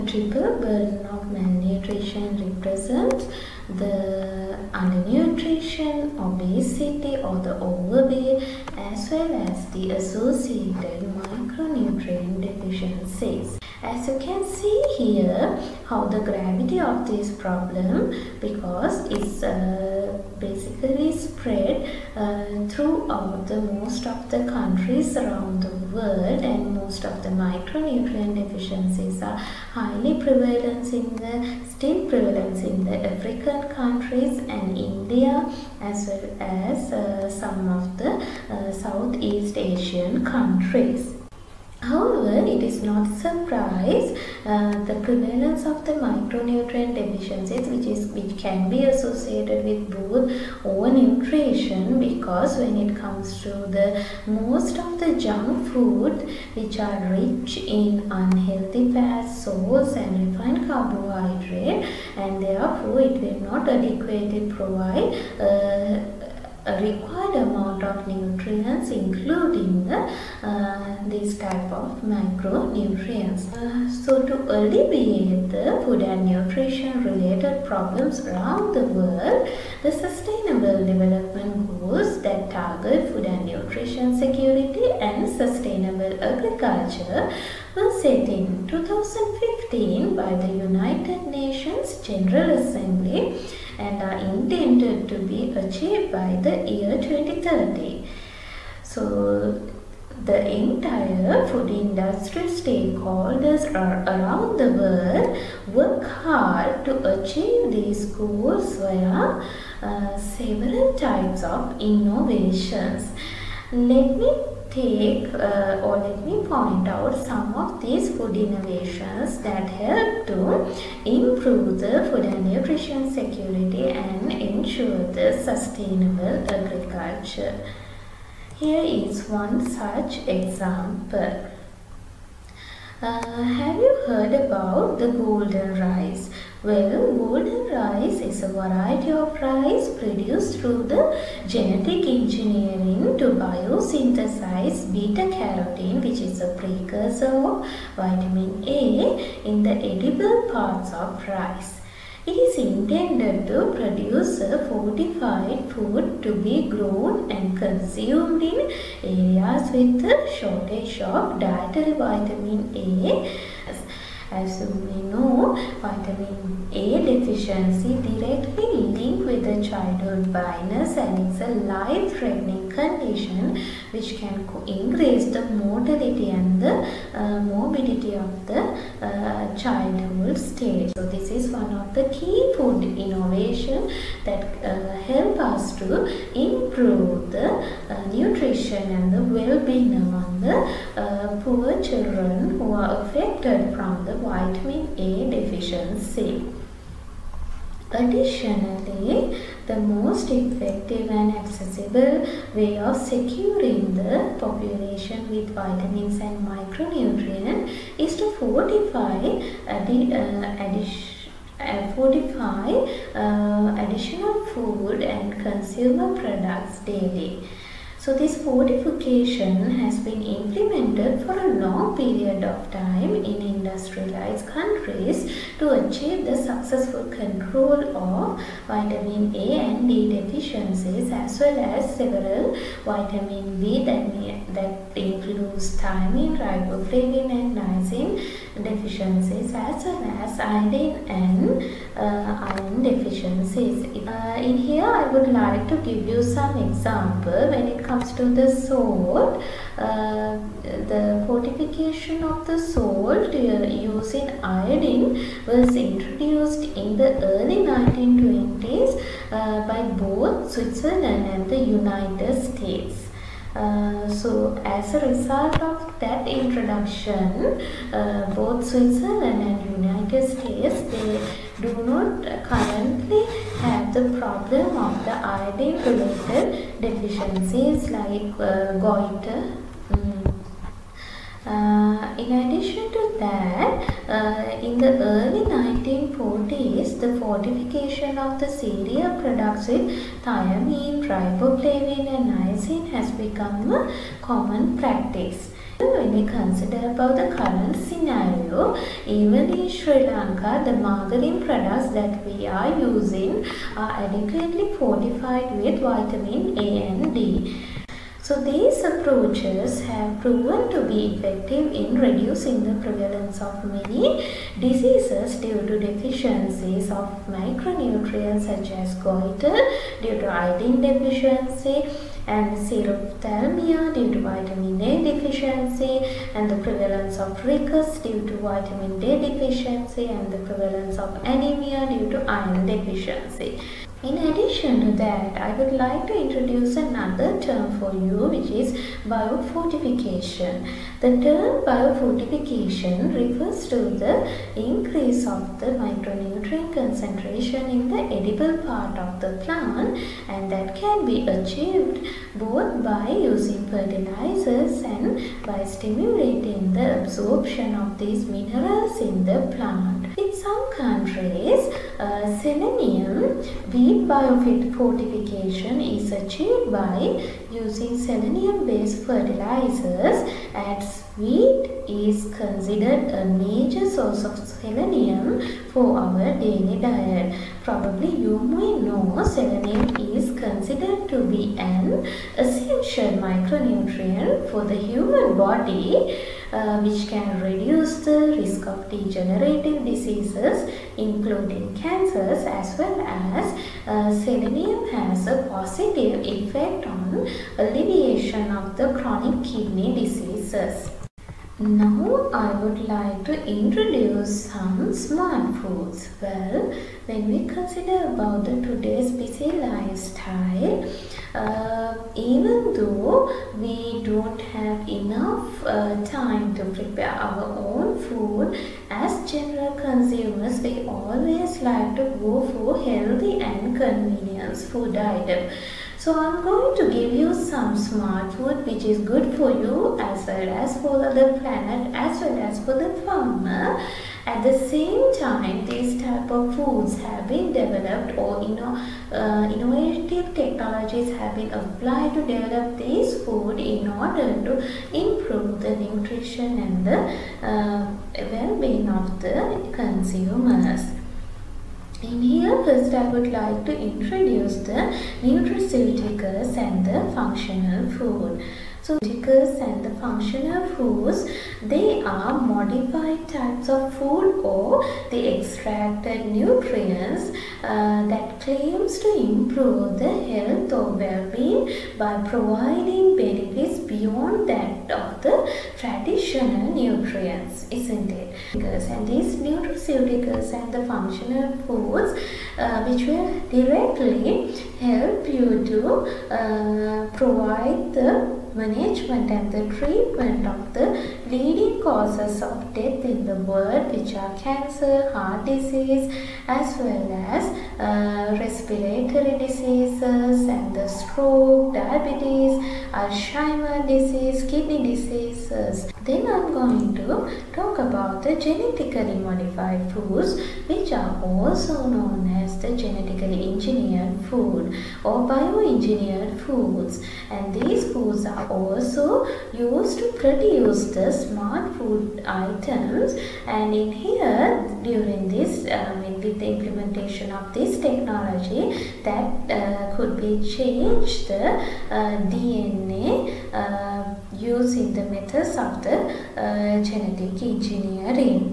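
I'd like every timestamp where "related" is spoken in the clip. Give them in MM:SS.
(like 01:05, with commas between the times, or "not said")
01:17, 04:35.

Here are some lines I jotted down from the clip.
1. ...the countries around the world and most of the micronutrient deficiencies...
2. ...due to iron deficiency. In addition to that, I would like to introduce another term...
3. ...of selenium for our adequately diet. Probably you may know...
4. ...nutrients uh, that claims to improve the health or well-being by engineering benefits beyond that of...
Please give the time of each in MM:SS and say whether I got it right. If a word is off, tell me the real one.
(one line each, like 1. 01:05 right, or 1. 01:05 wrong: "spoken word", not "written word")
1. 00:24 right
2. 05:31 right
3. 06:14 wrong: "daily", not "adequately"
4. 07:46 wrong: "providing", not "engineering".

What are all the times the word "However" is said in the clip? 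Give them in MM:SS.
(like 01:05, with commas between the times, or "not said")
00:41.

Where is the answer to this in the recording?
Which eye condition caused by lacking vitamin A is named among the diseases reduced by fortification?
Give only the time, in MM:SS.
05:22.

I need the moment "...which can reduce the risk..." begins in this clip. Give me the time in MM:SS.
06:26.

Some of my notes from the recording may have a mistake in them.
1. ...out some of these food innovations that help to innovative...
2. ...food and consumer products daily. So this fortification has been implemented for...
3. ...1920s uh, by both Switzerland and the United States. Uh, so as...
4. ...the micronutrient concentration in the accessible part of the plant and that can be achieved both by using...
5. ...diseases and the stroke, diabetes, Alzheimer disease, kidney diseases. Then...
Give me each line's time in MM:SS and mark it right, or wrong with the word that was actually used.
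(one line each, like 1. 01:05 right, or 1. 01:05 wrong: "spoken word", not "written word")
1. 01:56 wrong: "improve", not "innovative"
2. 03:34 right
3. 04:17 right
4. 05:45 wrong: "edible", not "accessible"
5. 08:19 right.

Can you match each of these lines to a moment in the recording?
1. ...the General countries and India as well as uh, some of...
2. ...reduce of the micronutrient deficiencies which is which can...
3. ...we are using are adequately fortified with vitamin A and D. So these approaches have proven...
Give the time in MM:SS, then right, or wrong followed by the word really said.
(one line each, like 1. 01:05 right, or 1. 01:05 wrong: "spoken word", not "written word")
1. 00:32 wrong: "African", not "General"
2. 00:45 wrong: "prevalence", not "reduce"
3. 05:02 right.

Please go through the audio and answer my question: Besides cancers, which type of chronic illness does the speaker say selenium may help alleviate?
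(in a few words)
chronic kidney diseases.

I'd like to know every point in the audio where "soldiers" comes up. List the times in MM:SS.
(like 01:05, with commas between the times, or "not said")
not said.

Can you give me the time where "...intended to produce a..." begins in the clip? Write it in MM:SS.
02:32.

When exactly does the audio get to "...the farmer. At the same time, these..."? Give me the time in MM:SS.
07:12.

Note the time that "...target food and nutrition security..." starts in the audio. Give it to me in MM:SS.
01:22.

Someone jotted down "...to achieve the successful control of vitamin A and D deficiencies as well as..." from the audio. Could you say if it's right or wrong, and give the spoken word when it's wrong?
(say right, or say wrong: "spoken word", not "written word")
right.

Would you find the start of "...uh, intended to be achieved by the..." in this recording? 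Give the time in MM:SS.
01:34.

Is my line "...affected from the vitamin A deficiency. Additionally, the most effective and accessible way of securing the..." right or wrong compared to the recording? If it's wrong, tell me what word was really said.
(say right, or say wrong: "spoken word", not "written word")
right.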